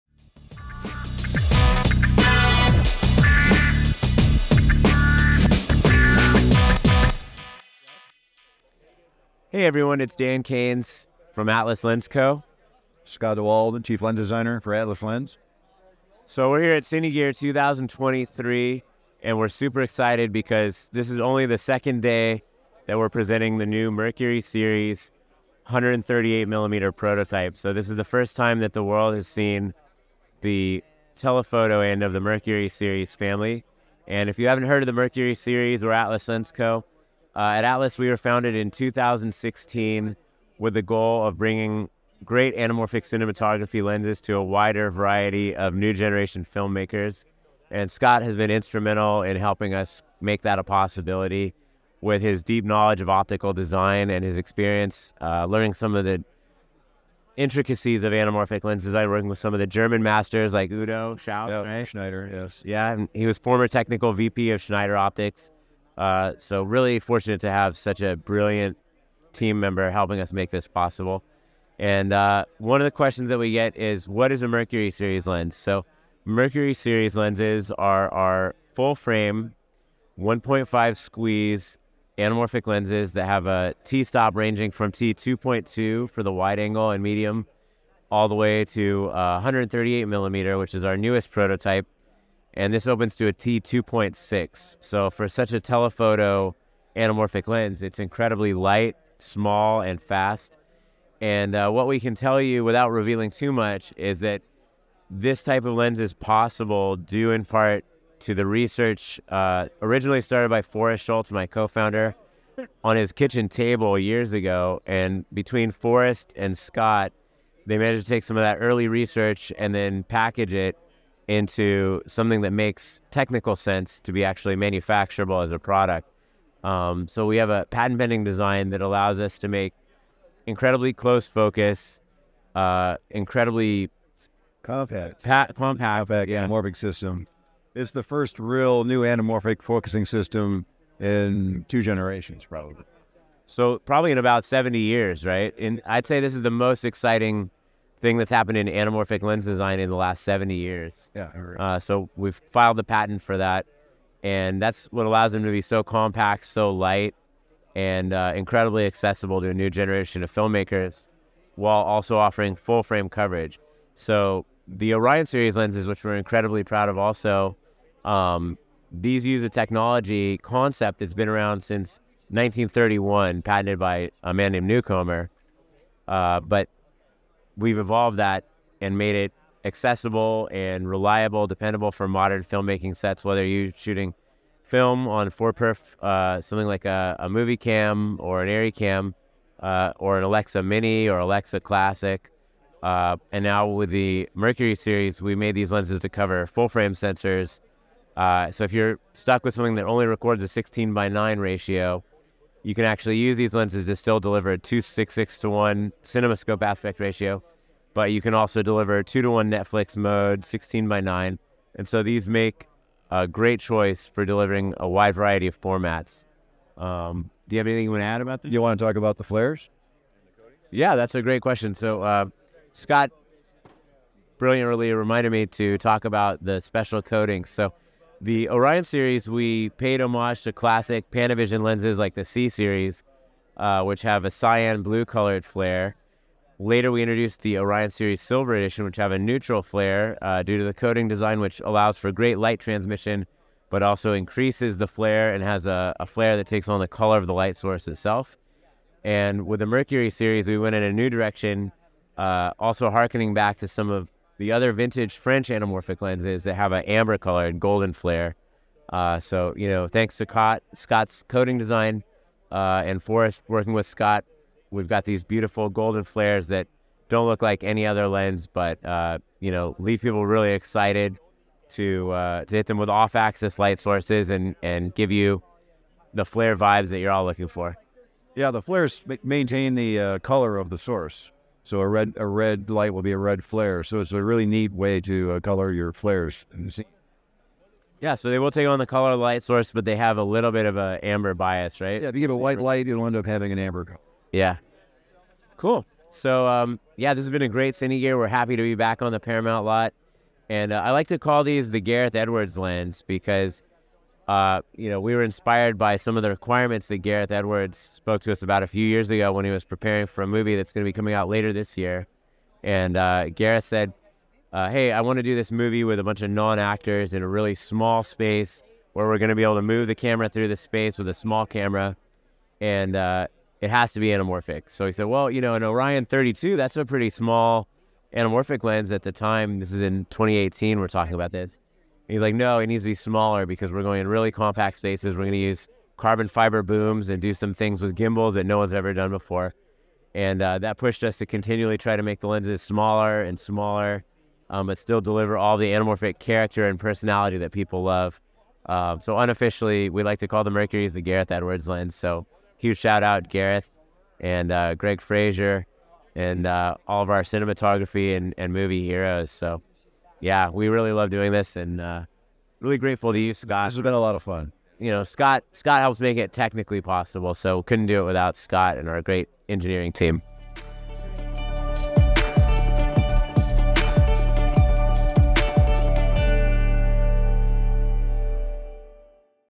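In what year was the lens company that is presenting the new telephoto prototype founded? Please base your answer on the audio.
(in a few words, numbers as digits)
2016.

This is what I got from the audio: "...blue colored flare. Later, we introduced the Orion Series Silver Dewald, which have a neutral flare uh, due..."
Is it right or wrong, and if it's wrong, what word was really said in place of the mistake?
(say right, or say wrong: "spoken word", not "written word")
wrong: "Edition", not "Dewald".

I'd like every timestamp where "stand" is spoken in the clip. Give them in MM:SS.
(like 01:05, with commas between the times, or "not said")
not said.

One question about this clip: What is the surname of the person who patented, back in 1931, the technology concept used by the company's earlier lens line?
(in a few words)
Newcomer.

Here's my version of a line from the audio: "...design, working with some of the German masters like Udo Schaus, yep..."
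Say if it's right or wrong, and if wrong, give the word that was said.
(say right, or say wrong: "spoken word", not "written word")
right.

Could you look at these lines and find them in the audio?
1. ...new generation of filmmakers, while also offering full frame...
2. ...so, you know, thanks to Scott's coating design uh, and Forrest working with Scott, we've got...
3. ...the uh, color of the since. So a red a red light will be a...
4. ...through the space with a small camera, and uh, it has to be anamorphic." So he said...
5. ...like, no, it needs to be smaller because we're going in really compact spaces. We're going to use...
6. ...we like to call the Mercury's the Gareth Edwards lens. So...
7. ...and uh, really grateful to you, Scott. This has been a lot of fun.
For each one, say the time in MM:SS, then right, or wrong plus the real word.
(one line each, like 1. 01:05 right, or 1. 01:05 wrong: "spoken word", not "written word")
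1. 02:39 right
2. 04:19 right
3. 04:39 wrong: "source", not "since"
4. 05:20 right
5. 05:32 right
6. 05:49 right
7. 06:01 right.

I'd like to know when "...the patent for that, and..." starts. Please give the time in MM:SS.
02:32.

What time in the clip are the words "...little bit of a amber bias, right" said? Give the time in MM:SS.
04:50.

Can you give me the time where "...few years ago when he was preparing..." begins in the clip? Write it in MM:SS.
05:08.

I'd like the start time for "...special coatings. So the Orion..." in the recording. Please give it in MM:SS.
03:46.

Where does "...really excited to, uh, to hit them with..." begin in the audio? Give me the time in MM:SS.
04:30.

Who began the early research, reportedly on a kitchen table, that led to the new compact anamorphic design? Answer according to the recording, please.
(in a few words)
Forrest Schultz.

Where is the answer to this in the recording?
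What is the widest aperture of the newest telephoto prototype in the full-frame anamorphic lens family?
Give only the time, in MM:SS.
01:33.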